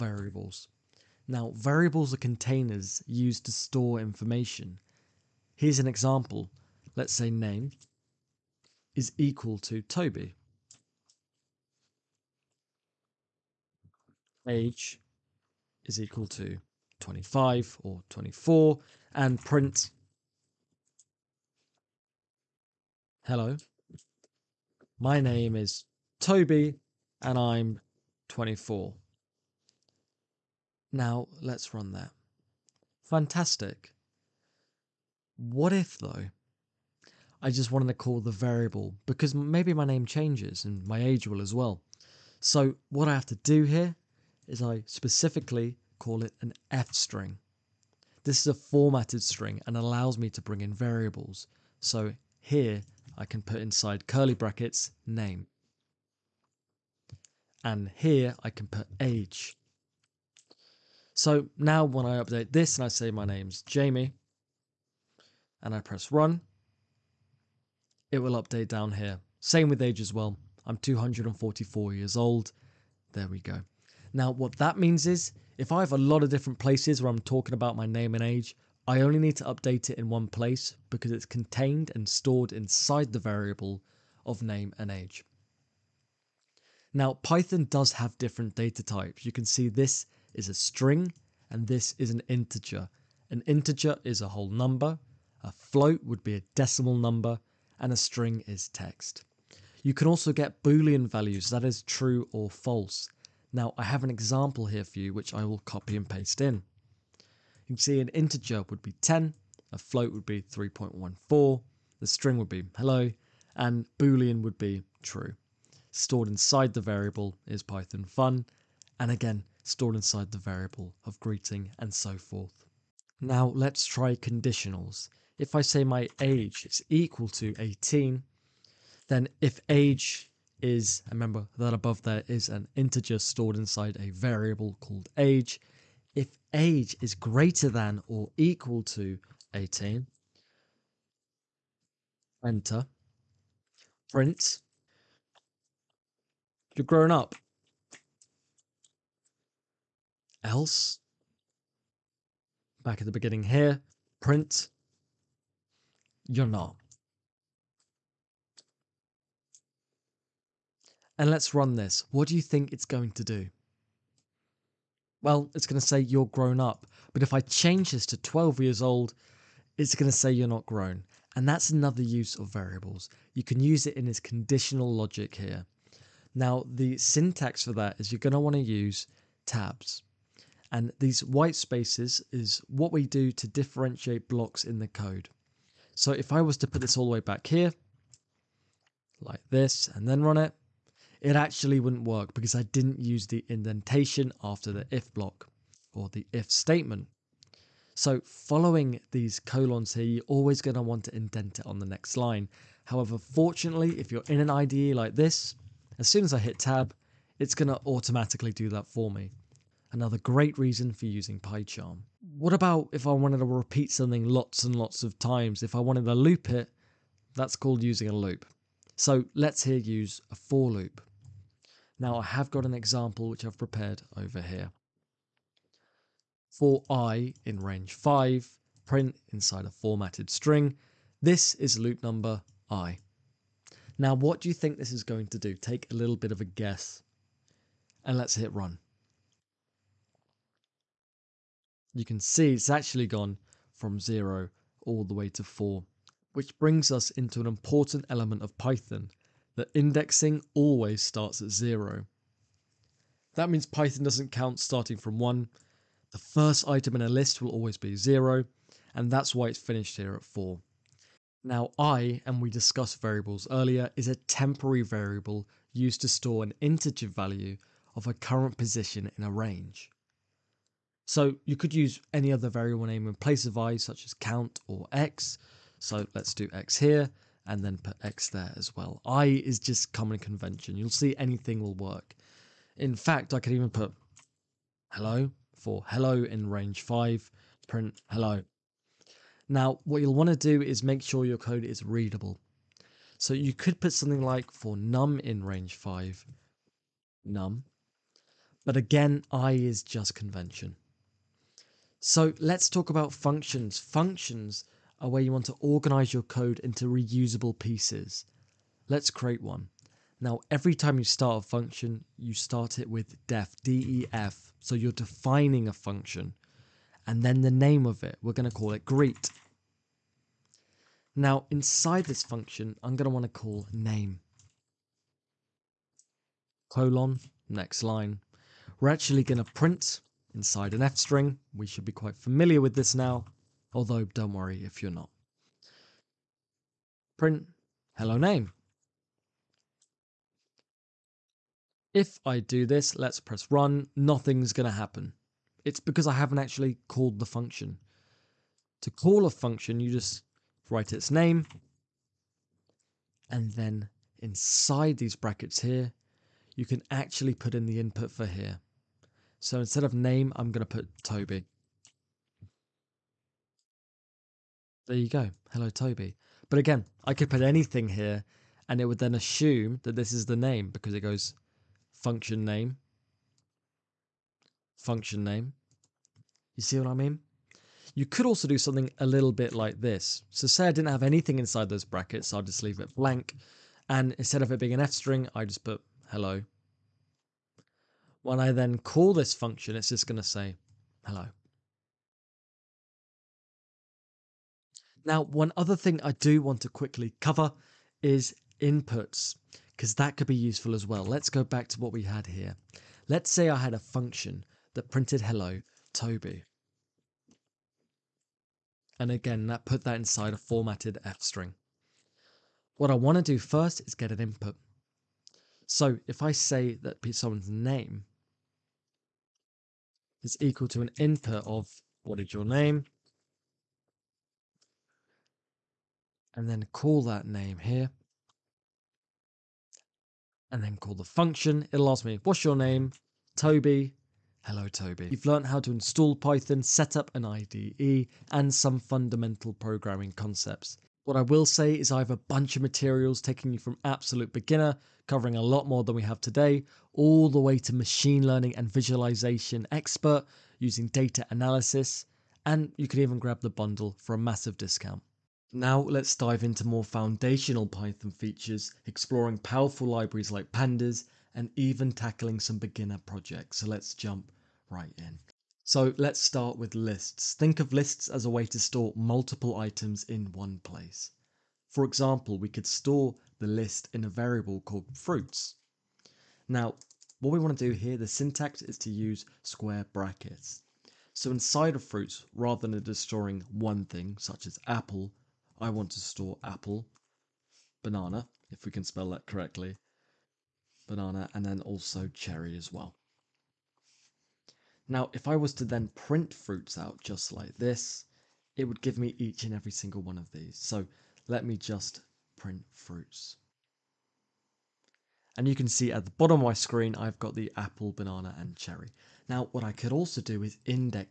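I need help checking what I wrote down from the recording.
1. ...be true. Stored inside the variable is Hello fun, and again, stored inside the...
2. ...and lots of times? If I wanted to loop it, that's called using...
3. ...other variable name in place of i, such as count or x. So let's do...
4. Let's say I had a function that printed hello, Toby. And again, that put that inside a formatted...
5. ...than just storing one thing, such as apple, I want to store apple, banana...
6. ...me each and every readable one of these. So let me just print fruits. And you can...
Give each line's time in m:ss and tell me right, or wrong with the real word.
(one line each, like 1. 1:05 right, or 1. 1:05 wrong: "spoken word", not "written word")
1. 1:54 wrong: "Python", not "Hello"
2. 3:34 right
3. 4:32 right
4. 6:43 right
5. 8:02 right
6. 8:18 wrong: "single", not "readable".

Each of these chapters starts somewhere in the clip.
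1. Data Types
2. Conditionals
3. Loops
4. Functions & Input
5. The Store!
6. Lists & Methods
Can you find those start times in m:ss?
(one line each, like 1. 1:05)
1. 1:25
2. 2:02
3. 3:28
4. 5:00
5. 7:18
6. 7:34.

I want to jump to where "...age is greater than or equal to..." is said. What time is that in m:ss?
2:16.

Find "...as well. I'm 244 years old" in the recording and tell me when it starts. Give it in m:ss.
1:09.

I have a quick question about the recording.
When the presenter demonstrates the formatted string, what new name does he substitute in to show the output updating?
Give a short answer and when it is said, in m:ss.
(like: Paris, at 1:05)
Jamie, at 1:03.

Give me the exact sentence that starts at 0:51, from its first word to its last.
So, here I can put inside curly brackets name.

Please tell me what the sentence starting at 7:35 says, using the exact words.
Now let's dive into more foundational Python features, exploring powerful libraries like pandas, and even tackling some beginner projects.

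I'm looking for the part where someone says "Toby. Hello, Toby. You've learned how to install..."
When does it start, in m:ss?
7:13.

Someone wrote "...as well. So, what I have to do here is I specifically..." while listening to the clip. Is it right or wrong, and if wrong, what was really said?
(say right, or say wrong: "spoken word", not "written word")
right.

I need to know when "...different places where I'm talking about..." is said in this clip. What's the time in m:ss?
1:16.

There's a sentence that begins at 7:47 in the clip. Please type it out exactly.
Think of lists as a way to store multiple items in one place.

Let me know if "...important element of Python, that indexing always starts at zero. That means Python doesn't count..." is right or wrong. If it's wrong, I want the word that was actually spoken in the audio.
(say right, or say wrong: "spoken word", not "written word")
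right.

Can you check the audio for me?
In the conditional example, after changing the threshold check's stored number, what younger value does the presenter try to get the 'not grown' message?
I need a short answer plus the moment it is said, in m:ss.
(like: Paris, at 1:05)
12, at 2:48.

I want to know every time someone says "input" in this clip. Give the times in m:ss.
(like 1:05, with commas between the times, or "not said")
5:57, 6:38, 6:54, 7:00.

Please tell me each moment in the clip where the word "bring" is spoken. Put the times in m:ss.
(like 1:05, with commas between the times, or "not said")
0:50, 4:06.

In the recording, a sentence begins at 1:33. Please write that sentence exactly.
An integer is a whole number, a float would be a decimal number, and a string is text.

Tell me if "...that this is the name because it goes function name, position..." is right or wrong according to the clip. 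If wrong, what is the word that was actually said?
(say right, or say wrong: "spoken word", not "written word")
wrong: "function", not "position".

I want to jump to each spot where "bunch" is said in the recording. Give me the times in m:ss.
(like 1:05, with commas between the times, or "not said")
7:22.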